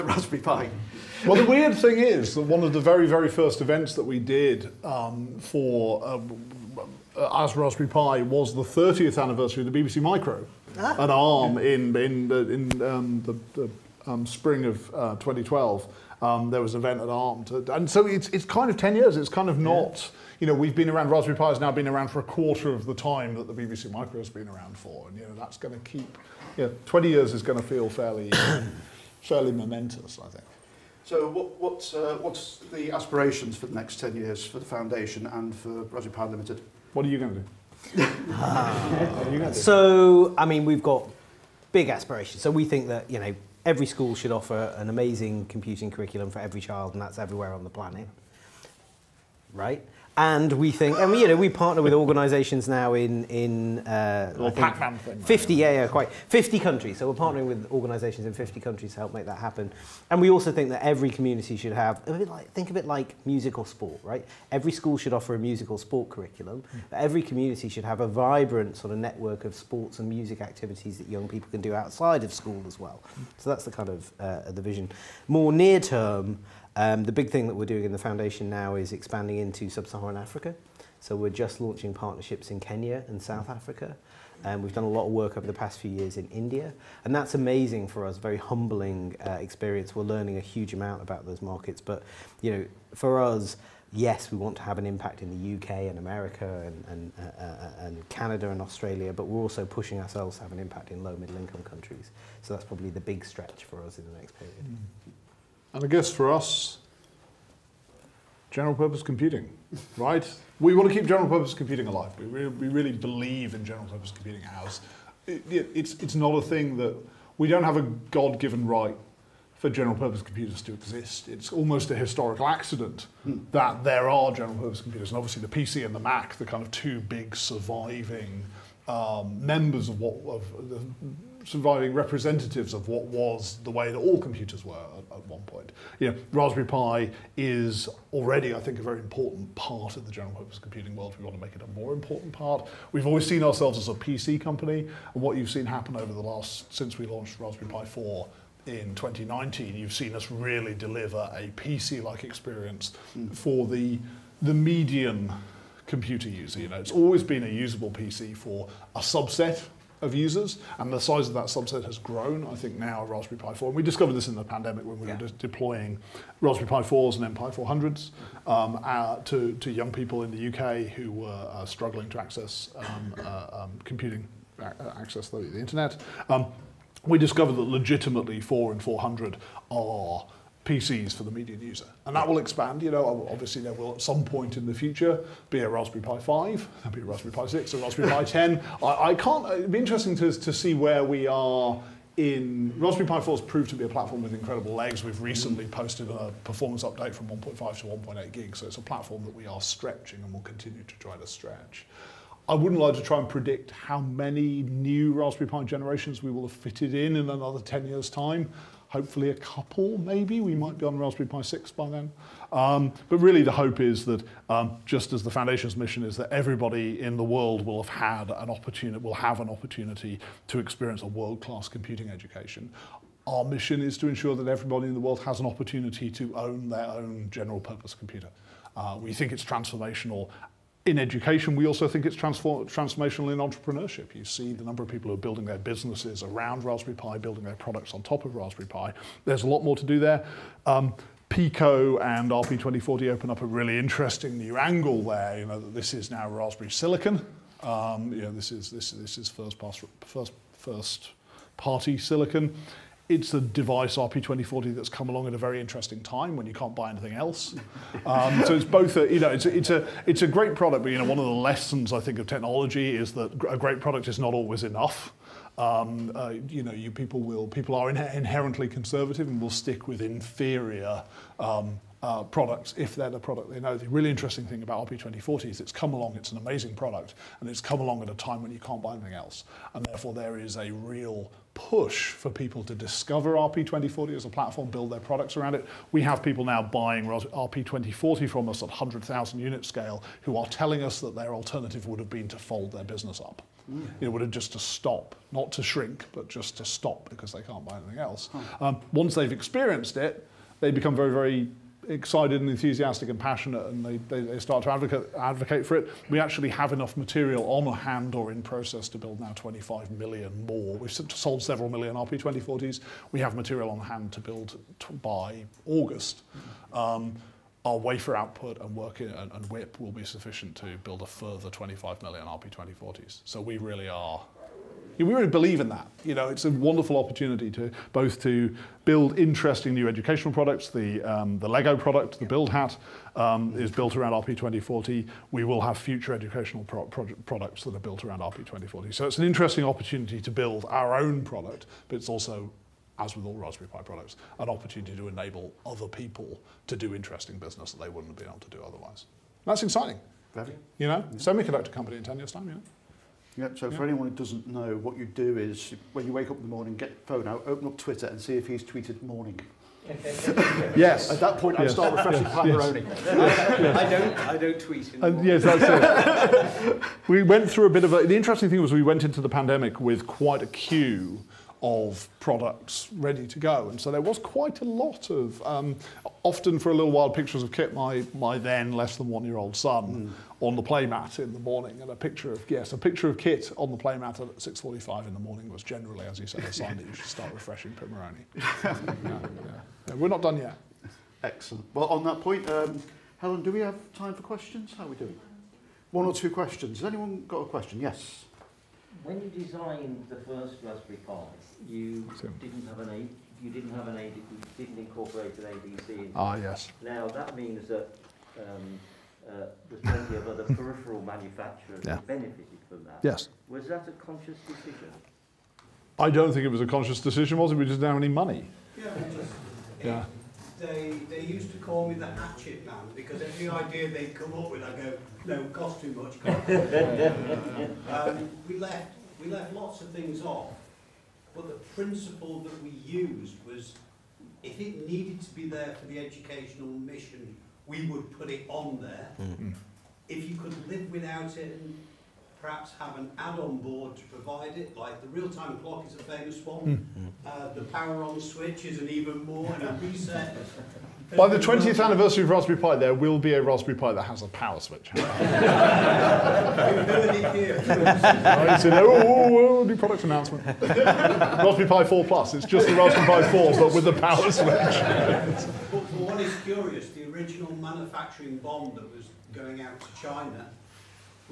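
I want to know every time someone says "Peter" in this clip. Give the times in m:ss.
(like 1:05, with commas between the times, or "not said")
not said.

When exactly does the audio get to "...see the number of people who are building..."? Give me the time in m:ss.
3:54.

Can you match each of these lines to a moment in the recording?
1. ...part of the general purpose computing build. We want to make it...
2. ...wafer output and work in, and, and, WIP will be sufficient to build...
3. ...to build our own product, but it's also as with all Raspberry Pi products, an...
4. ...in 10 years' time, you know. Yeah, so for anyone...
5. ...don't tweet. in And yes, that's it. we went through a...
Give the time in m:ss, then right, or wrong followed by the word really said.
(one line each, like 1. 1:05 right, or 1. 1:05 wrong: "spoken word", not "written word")
1. 2:19 wrong: "world", not "build"
2. 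5:17 right
3. 5:40 right
4. 5:51 right
5. 6:04 right.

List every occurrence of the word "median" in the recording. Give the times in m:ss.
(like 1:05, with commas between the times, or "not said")
2:34, 3:01.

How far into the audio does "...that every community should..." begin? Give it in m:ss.
1:00.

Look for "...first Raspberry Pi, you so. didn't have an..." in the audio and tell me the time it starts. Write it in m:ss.
6:40.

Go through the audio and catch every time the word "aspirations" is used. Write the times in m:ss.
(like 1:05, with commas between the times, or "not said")
0:32, 0:41.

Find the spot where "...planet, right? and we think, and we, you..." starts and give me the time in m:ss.
0:47.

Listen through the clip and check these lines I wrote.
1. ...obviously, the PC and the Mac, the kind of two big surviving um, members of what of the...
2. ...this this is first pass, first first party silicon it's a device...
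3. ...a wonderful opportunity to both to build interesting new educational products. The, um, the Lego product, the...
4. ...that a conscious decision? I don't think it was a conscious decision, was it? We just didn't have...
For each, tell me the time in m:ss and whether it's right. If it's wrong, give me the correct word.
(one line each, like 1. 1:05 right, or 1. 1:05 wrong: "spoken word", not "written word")
1. 2:05 right
2. 4:08 right
3. 5:26 right
4. 6:53 right.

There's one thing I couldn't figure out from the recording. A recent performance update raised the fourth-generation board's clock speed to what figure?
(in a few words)
1.8 gigs.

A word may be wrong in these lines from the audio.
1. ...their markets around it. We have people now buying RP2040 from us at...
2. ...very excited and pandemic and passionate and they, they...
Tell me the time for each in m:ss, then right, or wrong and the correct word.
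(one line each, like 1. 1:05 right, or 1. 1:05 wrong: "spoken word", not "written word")
1. 4:44 wrong: "products", not "markets"
2. 5:01 wrong: "enthusiastic", not "pandemic".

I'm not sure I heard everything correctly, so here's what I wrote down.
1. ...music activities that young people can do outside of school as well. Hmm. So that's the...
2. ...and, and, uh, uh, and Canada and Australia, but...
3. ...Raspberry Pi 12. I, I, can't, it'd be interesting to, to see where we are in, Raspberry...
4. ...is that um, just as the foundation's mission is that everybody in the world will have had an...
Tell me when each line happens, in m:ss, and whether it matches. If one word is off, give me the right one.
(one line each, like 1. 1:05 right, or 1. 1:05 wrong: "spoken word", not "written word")
1. 1:10 right
2. 1:36 right
3. 3:07 wrong: "10", not "12"
4. 3:33 right.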